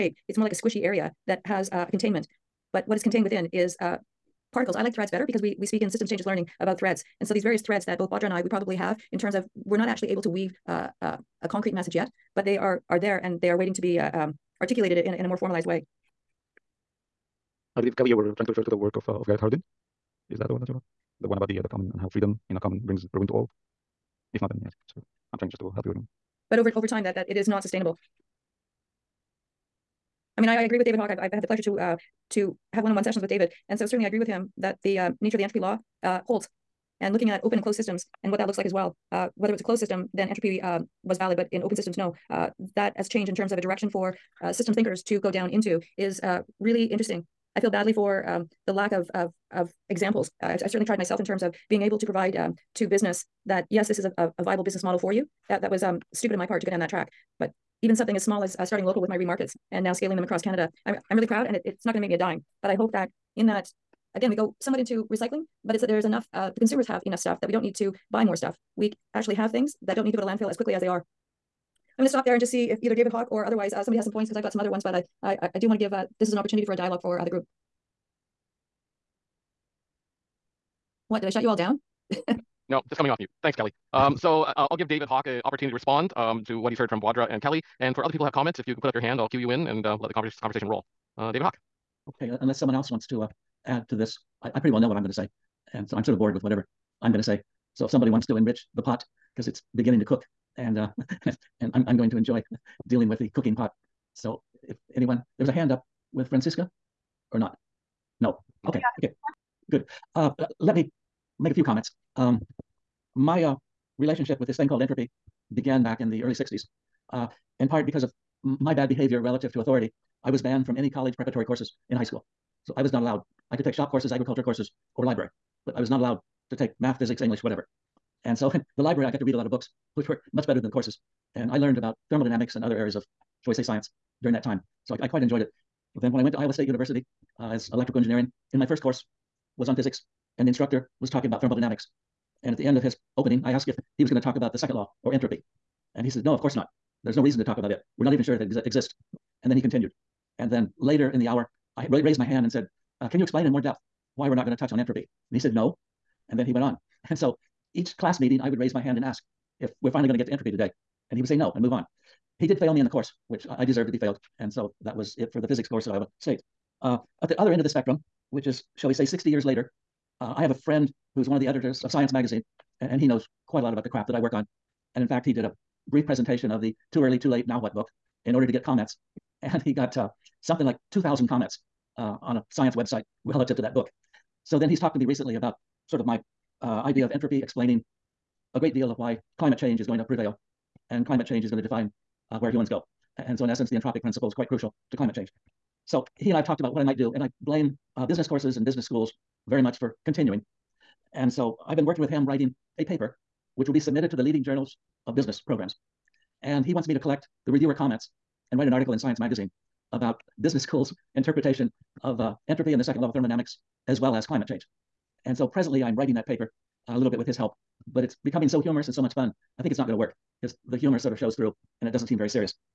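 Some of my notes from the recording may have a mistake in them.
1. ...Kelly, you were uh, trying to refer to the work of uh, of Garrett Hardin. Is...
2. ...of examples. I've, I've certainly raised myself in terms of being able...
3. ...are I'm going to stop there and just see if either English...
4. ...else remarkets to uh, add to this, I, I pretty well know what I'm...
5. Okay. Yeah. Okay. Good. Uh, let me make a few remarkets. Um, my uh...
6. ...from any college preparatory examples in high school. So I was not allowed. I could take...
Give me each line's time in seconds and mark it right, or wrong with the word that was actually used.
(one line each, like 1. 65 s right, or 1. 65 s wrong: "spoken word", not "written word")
1. 17 s right
2. 49 s wrong: "tried", not "raised"
3. 70 s wrong: "David", not "English"
4. 92 s wrong: "wants", not "remarkets"
5. 108 s wrong: "comments", not "remarkets"
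6. 120 s wrong: "courses", not "examples".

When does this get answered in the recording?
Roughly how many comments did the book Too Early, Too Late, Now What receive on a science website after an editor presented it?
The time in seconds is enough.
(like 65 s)
180 s.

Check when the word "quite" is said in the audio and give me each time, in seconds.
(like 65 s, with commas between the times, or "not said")
135 s, 173 s, 194 s.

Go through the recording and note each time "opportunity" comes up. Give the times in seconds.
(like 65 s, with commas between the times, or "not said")
76 s, 85 s.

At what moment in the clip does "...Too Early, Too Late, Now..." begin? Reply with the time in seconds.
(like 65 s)
176 s.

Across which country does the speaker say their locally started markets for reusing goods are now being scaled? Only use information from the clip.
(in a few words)
Canada.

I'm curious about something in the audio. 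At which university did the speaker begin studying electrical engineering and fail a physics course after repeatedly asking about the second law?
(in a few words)
Iowa State University.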